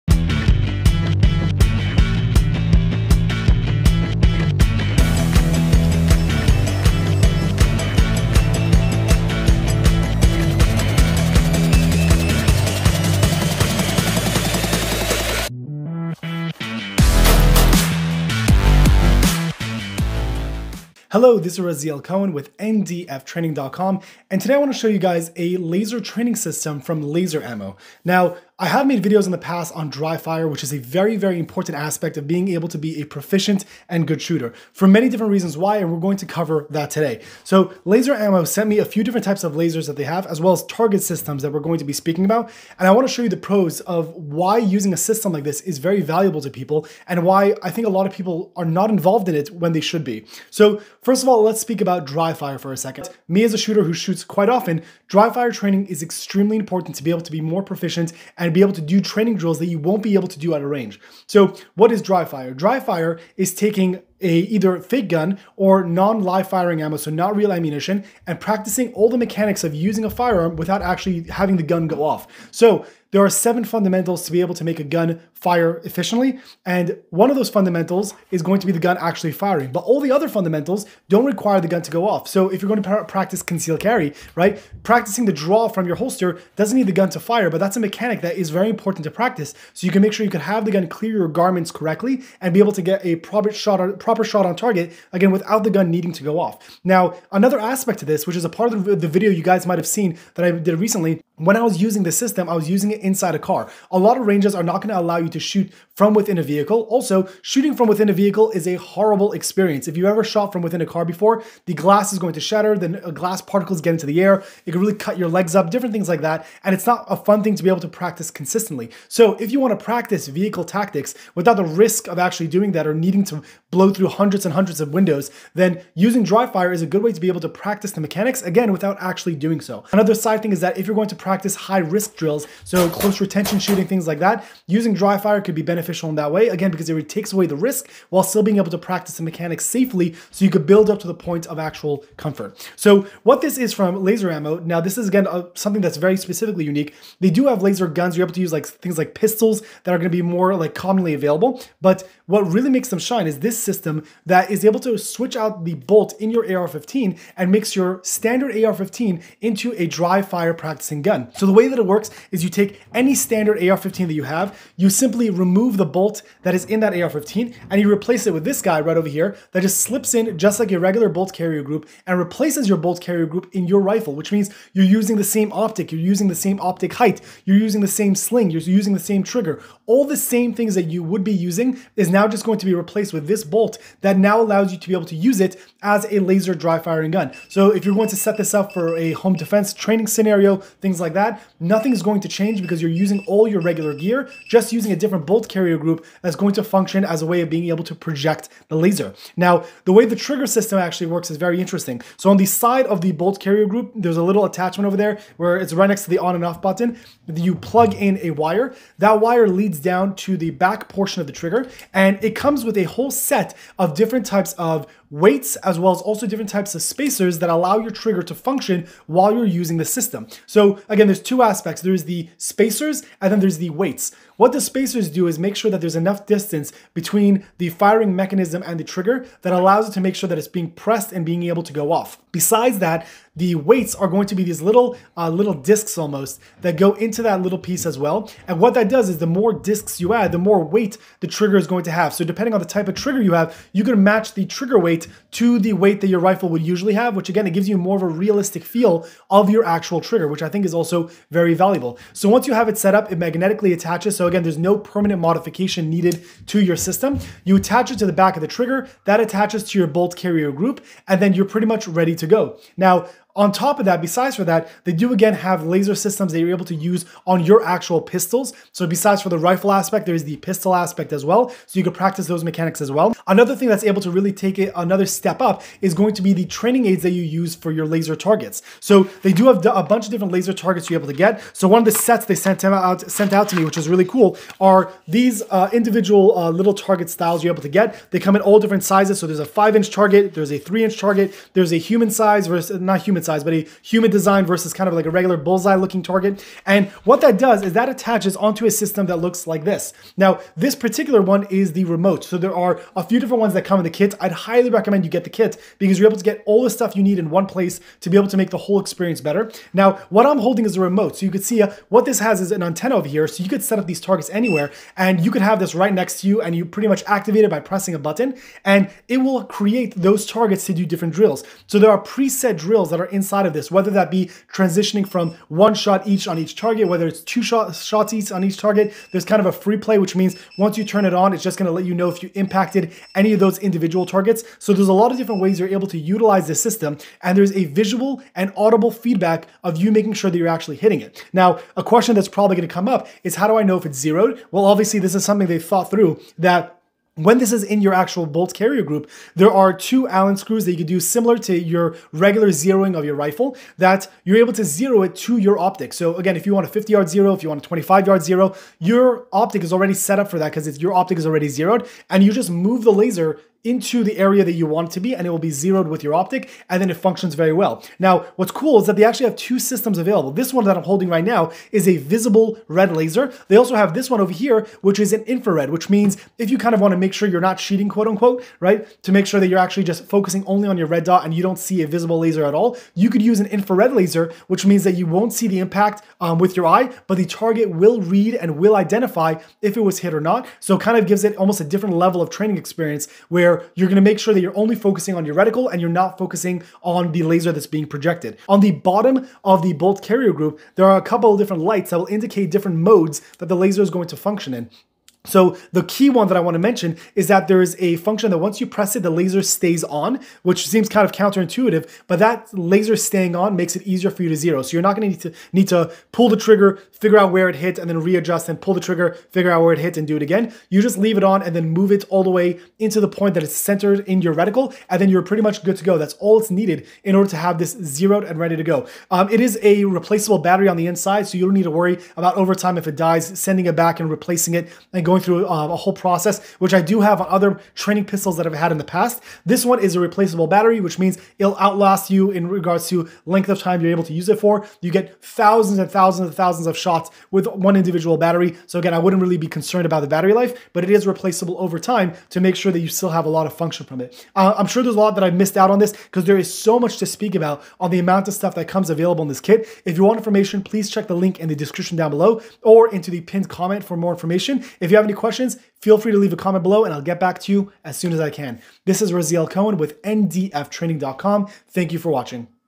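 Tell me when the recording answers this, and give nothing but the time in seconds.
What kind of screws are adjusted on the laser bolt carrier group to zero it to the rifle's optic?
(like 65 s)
350 s.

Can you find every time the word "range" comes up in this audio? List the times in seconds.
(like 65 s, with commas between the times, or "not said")
60 s, 104 s.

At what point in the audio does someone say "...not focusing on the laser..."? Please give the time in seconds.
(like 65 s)
395 s.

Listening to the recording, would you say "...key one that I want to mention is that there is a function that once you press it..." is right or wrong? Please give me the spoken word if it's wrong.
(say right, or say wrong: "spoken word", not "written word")
right.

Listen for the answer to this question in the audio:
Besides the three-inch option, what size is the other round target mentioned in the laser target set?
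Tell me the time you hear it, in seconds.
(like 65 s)
289 s.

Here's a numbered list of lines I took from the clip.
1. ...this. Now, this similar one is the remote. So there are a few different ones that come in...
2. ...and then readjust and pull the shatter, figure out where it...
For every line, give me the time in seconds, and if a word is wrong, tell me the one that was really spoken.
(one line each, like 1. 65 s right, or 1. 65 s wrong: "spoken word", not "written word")
1. 299 s wrong: "particular", not "similar"
2. 417 s wrong: "trigger", not "shatter".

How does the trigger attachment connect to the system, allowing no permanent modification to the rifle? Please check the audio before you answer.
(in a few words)
Magnetically.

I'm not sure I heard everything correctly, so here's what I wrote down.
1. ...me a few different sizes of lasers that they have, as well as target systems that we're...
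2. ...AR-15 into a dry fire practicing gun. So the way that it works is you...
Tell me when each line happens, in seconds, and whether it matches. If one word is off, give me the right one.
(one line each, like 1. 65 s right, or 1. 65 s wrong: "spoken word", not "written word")
1. 38 s wrong: "types", not "sizes"
2. 158 s right.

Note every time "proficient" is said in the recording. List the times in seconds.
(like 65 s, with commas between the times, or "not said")
33 s, 57 s.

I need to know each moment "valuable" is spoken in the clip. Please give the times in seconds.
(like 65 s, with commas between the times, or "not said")
46 s, 251 s.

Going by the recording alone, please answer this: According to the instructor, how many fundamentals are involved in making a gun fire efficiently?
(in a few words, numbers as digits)
7.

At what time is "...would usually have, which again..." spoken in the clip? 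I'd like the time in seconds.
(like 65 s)
246 s.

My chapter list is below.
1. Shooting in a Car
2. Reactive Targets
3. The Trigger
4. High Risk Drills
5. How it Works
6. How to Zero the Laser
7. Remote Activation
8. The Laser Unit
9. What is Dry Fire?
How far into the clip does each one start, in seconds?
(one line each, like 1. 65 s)
1. 96 s
2. 272 s
3. 199 s
4. 127 s
5. 161 s
6. 340 s
7. 298 s
8. 141 s
9. 50 s.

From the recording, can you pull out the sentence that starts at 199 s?
Now, the way the trigger system actually works is very interesting.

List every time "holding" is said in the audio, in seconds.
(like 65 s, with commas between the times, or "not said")
310 s, 370 s.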